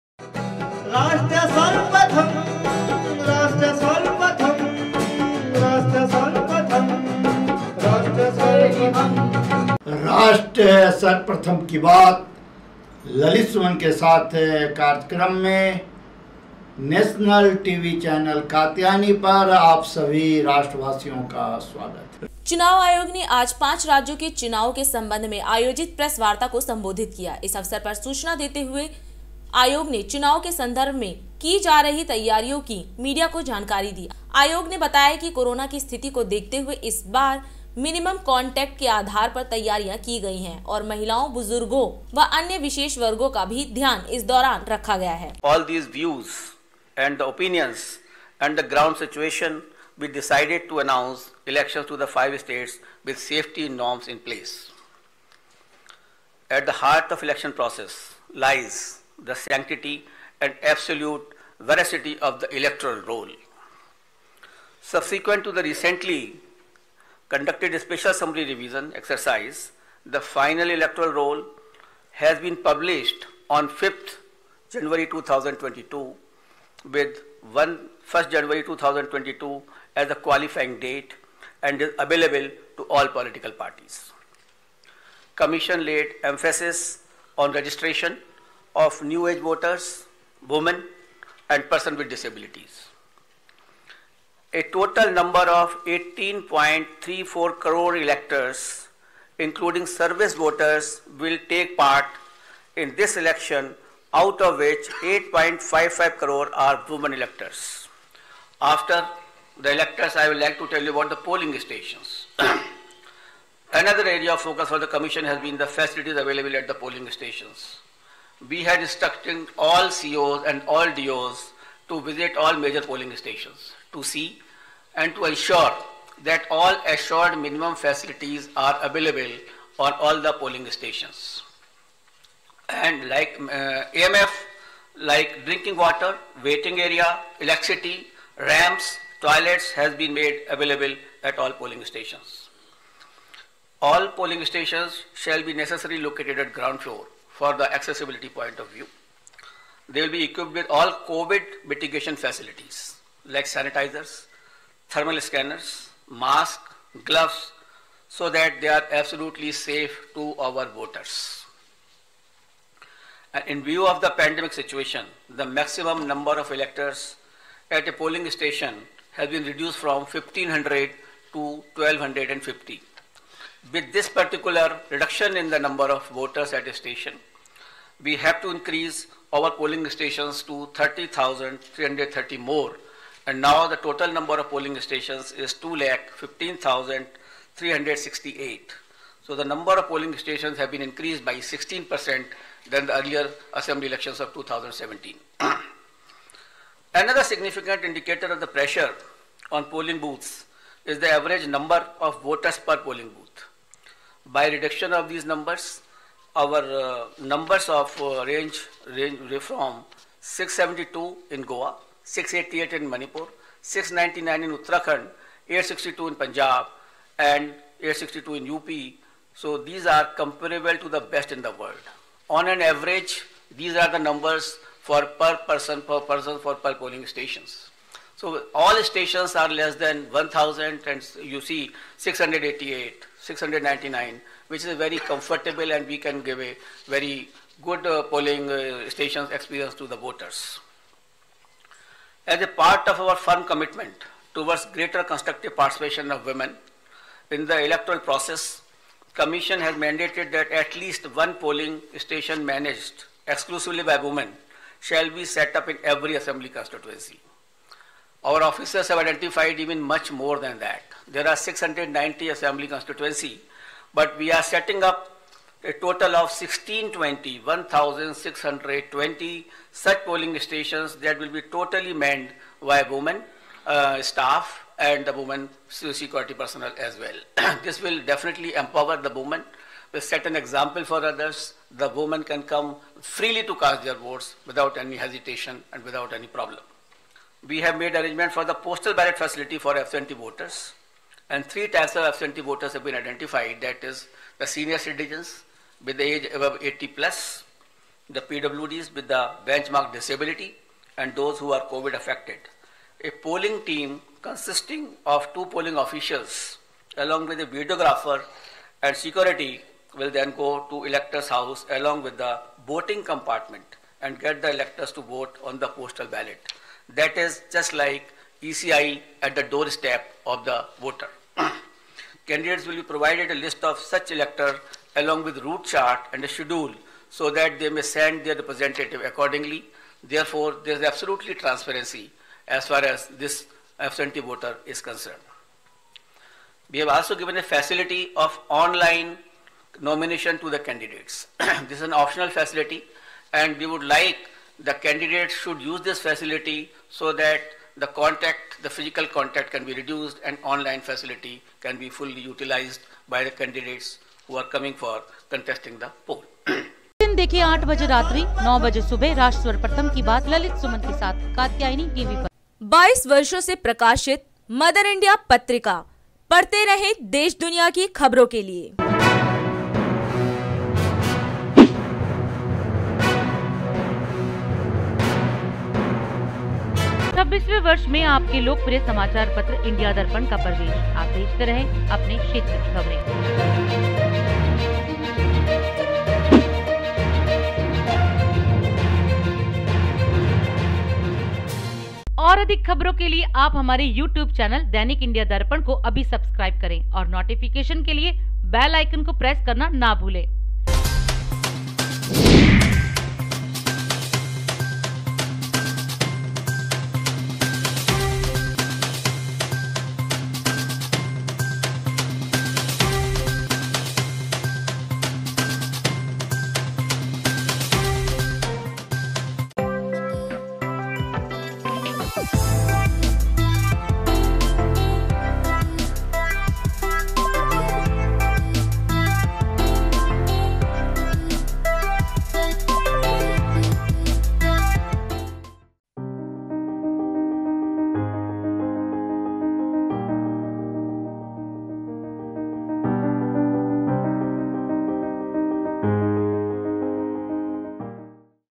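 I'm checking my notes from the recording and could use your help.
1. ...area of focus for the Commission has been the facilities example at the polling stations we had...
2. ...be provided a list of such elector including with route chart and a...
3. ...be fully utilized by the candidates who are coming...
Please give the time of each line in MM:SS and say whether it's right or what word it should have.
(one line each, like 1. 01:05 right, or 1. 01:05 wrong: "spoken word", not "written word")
1. 01:54 wrong: "available", not "example"
2. 05:22 wrong: "along", not "including"
3. 05:51 right.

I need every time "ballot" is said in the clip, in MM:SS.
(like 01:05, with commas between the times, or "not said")
04:48, 05:16.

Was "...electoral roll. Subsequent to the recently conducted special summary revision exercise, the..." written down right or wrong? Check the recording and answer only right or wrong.
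right.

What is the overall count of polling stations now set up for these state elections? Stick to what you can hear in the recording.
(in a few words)
2,15,368.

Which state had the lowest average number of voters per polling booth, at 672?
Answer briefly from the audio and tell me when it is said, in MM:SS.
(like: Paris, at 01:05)
Goa, at 03:31.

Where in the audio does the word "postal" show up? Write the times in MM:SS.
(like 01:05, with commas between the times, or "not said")
04:48, 05:15.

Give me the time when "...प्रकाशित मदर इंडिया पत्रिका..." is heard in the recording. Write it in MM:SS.
06:03.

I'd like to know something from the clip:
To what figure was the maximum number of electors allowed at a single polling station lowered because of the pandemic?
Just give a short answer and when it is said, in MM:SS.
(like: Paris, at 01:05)
1250, at 02:51.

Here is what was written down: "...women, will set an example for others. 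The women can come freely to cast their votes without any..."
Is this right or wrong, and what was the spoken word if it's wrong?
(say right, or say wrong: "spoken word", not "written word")
right.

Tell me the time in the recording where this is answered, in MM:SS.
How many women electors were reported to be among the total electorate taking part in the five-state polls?
01:45.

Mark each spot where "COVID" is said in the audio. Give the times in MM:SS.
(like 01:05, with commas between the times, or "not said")
02:31, 05:01.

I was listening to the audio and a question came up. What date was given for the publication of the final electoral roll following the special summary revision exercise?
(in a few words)
5 January 2022.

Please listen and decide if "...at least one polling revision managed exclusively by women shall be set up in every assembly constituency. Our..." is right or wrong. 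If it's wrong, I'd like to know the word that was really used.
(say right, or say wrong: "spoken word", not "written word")
wrong: "station", not "revision".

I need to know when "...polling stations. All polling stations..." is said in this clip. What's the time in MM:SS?
02:21.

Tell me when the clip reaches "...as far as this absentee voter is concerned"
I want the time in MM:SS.
05:32.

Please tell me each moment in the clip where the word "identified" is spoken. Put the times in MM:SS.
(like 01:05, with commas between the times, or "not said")
04:18, 04:52.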